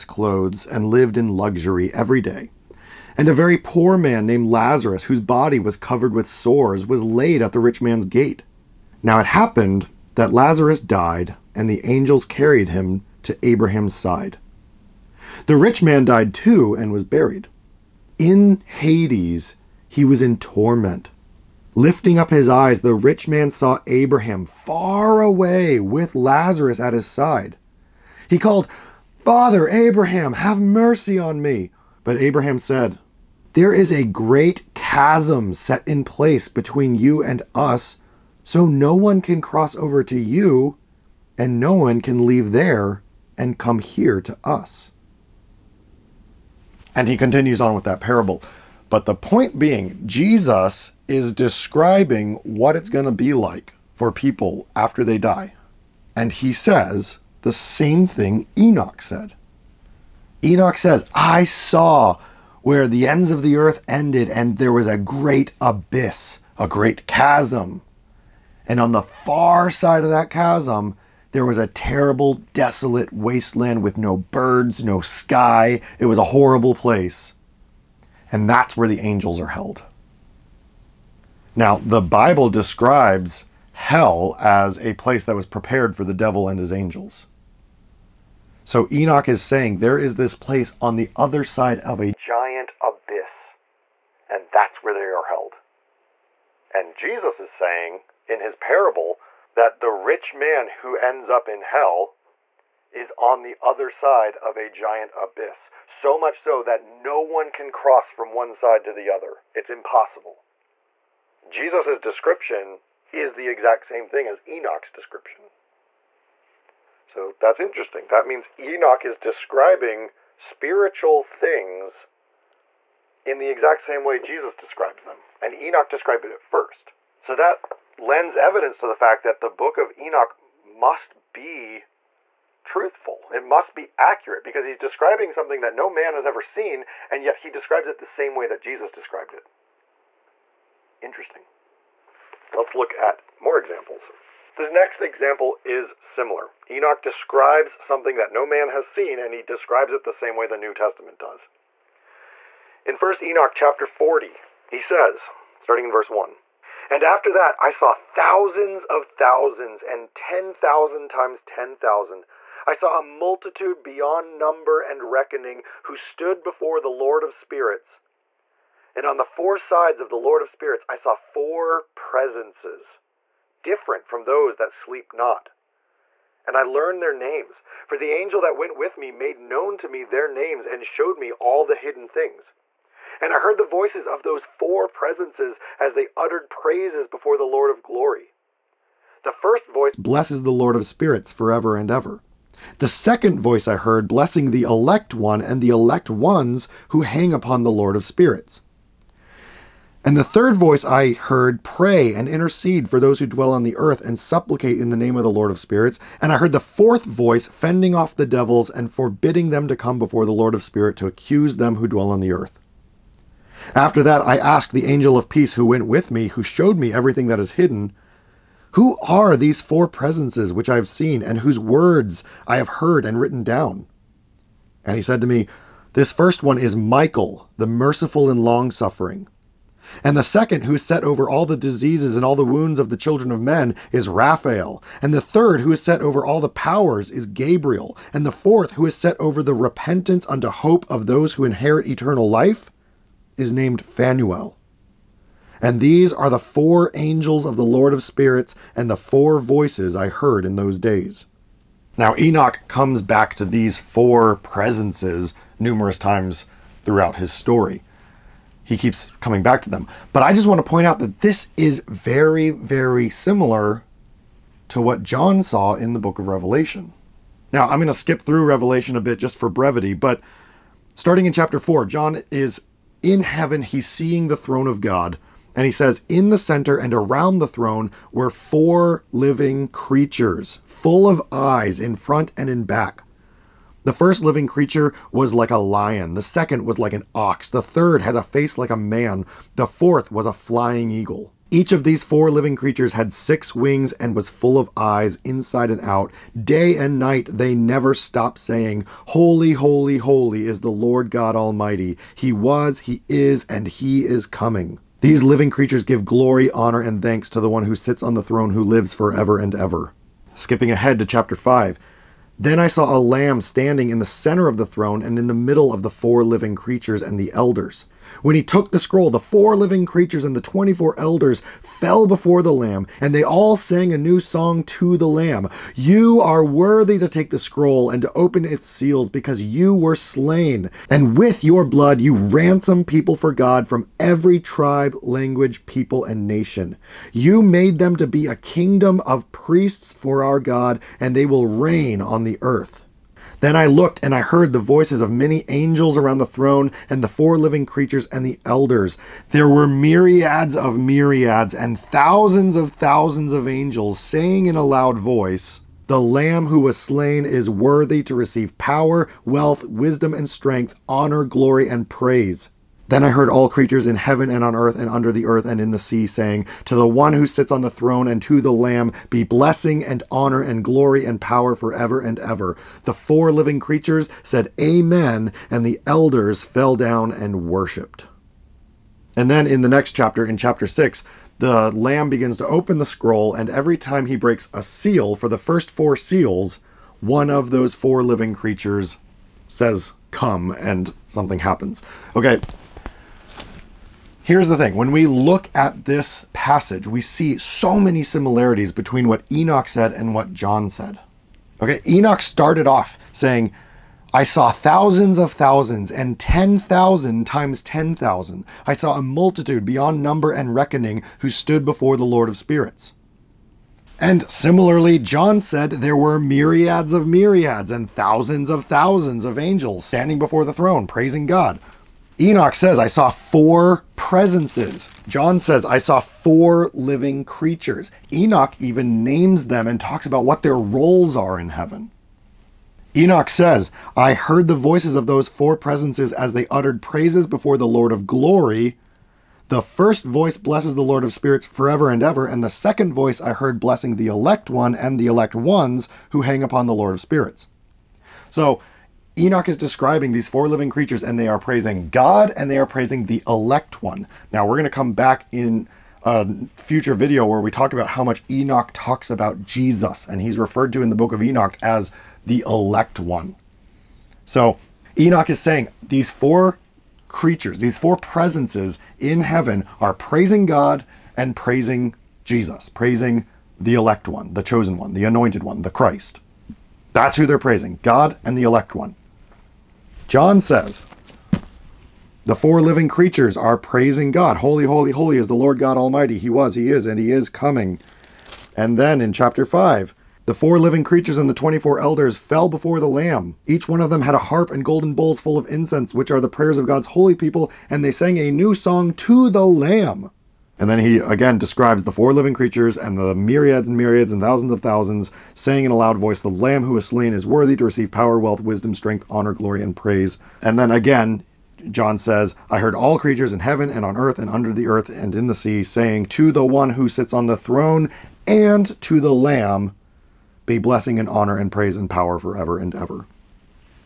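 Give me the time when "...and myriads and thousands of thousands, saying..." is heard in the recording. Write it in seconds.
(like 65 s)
503 s.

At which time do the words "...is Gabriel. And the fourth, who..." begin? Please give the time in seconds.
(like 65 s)
237 s.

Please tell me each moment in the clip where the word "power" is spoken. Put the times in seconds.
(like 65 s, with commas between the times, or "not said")
236 s, 358 s, 371 s, 507 s, 521 s.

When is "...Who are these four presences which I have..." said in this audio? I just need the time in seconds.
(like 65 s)
218 s.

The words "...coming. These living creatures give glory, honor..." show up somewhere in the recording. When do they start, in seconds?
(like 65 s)
304 s.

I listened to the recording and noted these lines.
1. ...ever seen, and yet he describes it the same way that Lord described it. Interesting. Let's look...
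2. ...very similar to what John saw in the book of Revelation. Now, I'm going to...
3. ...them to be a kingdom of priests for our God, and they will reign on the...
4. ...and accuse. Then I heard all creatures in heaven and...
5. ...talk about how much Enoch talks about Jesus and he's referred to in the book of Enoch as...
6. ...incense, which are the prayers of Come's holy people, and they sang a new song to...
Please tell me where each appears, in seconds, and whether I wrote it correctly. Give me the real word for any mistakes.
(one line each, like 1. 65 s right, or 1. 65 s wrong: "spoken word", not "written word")
1. 136 s wrong: "Jesus", not "Lord"
2. 262 s right
3. 337 s right
4. 361 s wrong: "praise", not "accuse"
5. 457 s right
6. 495 s wrong: "God", not "Come".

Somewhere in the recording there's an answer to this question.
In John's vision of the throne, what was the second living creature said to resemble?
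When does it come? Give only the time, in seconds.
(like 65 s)
286 s.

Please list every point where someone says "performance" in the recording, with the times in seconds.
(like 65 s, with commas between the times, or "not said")
not said.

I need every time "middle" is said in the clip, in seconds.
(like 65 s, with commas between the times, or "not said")
315 s.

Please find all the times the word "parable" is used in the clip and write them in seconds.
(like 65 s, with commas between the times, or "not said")
47 s, 98 s.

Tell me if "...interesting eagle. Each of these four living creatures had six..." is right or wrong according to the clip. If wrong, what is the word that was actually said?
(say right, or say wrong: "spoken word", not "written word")
wrong: "flying", not "interesting".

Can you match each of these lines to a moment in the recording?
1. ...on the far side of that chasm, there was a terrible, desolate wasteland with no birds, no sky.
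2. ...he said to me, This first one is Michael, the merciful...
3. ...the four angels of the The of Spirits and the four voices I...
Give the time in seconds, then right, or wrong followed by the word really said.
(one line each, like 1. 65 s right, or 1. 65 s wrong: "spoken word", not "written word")
1. 68 s right
2. 224 s right
3. 246 s wrong: "Lord", not "The".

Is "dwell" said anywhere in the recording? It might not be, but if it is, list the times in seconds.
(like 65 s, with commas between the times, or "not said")
203 s, 211 s.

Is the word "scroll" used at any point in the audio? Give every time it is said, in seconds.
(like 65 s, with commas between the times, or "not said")
318 s, 327 s, 382 s.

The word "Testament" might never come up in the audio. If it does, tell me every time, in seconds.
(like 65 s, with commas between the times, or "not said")
150 s.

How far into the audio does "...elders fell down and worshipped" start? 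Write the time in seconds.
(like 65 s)
375 s.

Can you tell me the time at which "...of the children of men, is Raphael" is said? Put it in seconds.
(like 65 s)
232 s.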